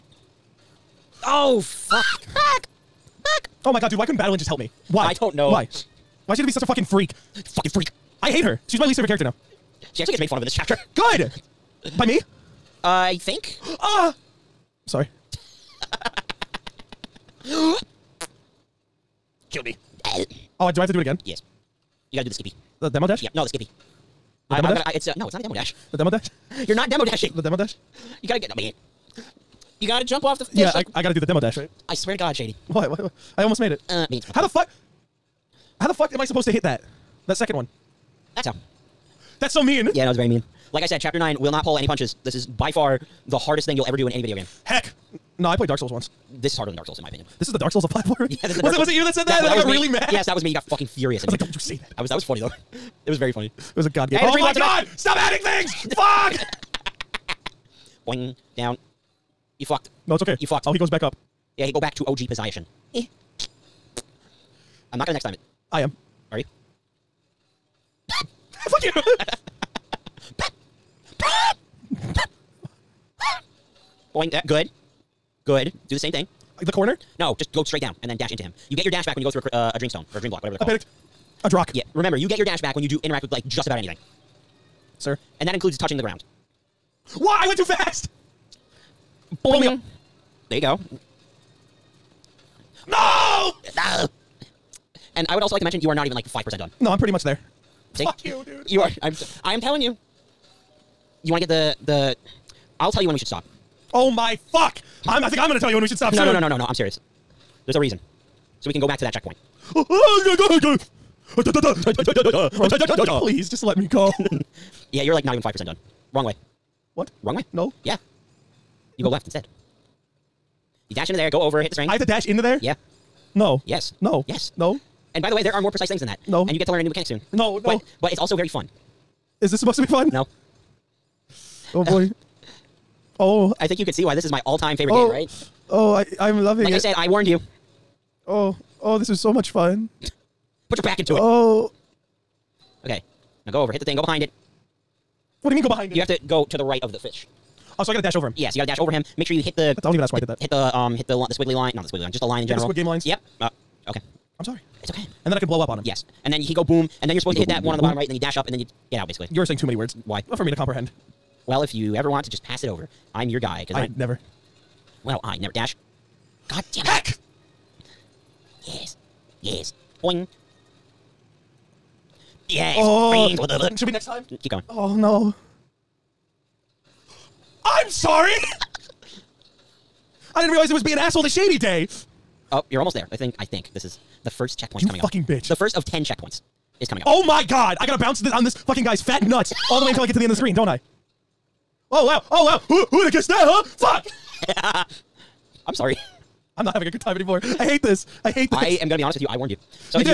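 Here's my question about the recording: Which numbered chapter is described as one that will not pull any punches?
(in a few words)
chapter 9.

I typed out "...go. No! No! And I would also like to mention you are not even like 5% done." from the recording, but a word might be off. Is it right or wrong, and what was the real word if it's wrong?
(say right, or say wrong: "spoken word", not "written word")
right.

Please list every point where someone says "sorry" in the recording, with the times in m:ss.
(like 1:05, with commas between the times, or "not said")
0:14, 2:34, 2:57, 3:15.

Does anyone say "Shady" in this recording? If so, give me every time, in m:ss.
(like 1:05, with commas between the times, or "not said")
0:32, 3:01.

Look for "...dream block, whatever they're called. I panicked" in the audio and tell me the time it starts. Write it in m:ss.
1:20.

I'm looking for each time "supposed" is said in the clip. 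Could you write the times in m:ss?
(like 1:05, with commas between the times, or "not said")
0:36, 2:09, 2:37.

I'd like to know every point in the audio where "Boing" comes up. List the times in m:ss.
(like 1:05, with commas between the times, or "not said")
0:58, 1:14, 1:29, 2:50.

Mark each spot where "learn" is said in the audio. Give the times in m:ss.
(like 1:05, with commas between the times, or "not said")
2:06.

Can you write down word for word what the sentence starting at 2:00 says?
You dash into there, go over, hit the spring.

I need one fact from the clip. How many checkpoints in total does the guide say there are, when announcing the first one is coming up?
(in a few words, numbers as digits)
10.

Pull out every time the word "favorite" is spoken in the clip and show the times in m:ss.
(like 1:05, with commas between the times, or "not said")
0:08, 2:14.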